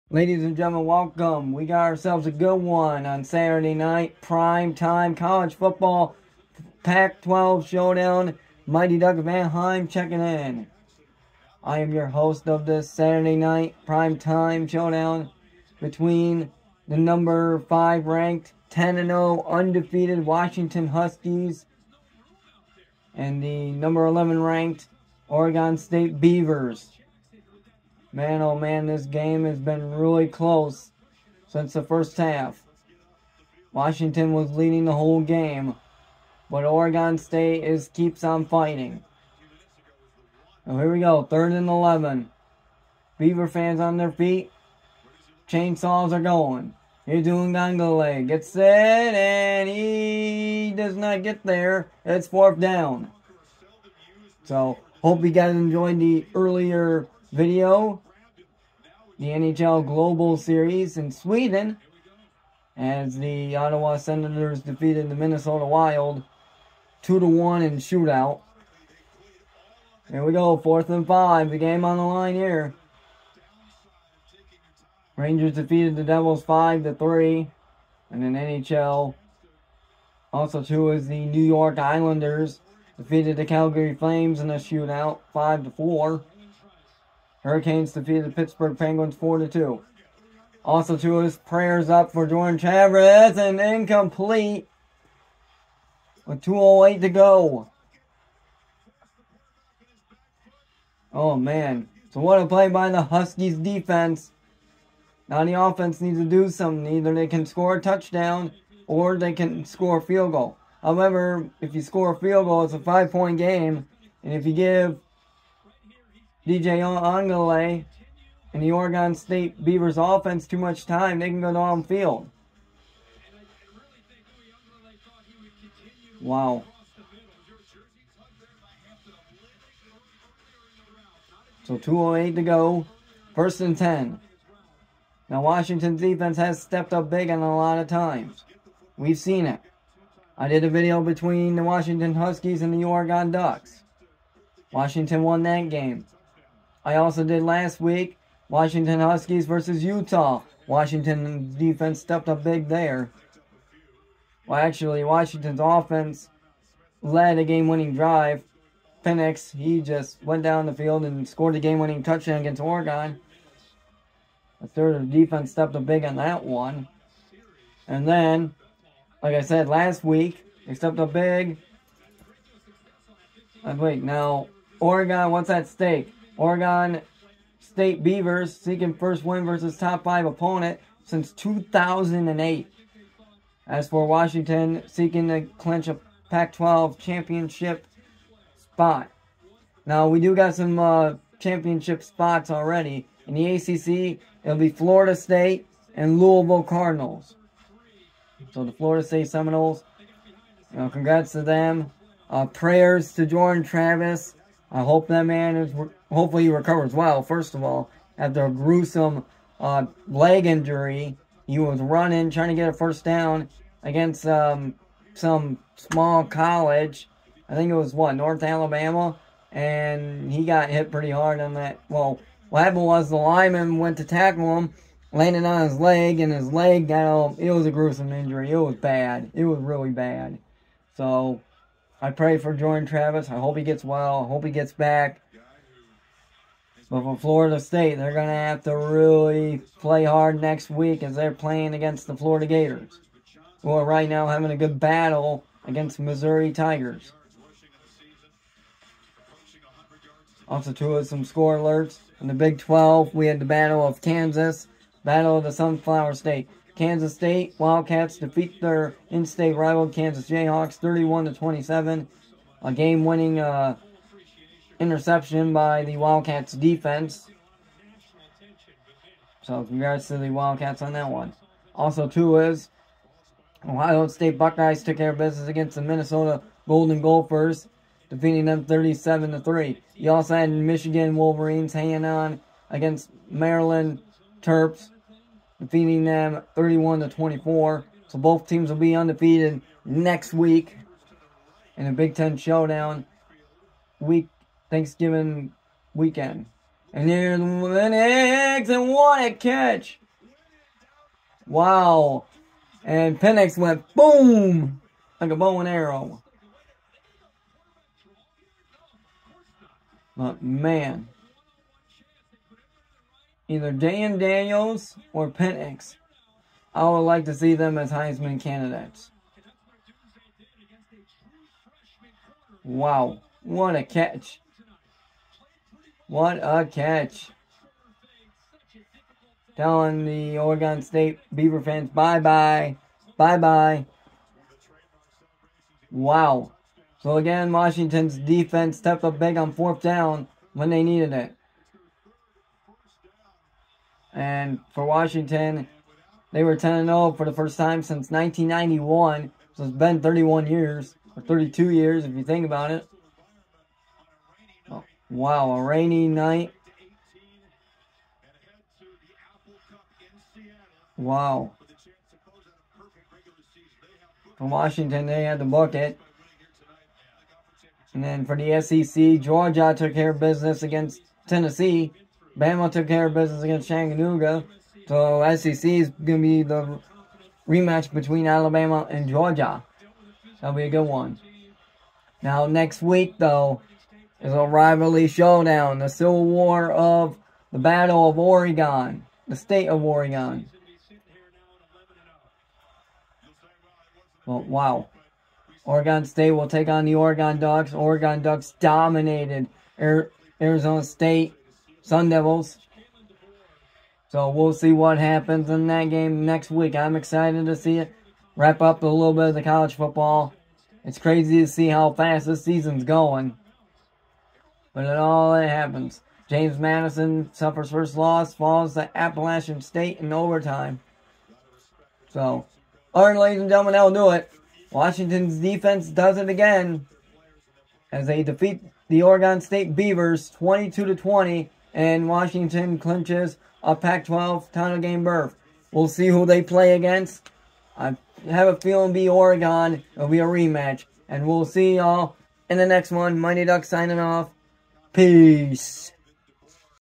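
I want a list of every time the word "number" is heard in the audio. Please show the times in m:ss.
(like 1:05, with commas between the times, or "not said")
0:16, 0:23.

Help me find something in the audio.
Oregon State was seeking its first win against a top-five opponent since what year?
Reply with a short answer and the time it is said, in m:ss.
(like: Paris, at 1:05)
2008, at 3:01.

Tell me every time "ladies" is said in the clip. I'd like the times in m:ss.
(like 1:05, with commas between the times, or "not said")
0:00, 7:03.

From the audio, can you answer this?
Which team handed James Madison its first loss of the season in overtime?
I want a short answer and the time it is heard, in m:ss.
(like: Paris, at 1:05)
Appalachian State, at 6:58.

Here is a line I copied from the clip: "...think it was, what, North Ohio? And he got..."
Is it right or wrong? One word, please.
wrong.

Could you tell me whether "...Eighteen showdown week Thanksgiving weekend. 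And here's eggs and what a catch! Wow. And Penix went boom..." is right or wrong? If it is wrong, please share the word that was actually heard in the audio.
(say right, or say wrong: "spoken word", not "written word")
wrong: "Ten", not "Eighteen".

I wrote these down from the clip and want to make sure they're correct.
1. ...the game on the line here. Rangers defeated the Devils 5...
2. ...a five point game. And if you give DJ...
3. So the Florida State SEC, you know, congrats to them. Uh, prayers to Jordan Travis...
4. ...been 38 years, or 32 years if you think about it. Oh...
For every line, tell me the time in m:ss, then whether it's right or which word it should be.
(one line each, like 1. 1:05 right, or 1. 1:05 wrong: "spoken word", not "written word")
1. 1:11 right
2. 1:52 right
3. 3:18 wrong: "Seminoles", not "SEC"
4. 5:49 wrong: "31", not "38".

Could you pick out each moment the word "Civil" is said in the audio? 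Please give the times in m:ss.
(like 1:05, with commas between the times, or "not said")
6:25.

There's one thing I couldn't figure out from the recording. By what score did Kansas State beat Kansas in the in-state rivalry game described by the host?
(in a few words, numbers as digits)
31 to 27.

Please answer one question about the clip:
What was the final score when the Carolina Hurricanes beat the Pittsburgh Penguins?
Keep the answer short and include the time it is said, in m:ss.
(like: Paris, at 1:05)
4-2, at 1:29.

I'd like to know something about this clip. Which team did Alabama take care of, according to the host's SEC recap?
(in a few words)
Chattanooga.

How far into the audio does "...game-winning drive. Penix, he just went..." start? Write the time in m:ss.
2:37.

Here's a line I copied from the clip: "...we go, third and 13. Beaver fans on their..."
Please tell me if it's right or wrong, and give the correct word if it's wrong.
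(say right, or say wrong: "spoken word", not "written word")
wrong: "11", not "13".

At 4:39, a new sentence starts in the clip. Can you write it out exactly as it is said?
You also had Michigan Wolverines hanging on against Maryland Terps, defeating them 31 to 24.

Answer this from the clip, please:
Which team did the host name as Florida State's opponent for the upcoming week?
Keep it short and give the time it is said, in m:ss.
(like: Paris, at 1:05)
Florida Gators, at 4:02.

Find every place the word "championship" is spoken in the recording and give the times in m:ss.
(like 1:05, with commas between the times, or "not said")
3:06, 3:11.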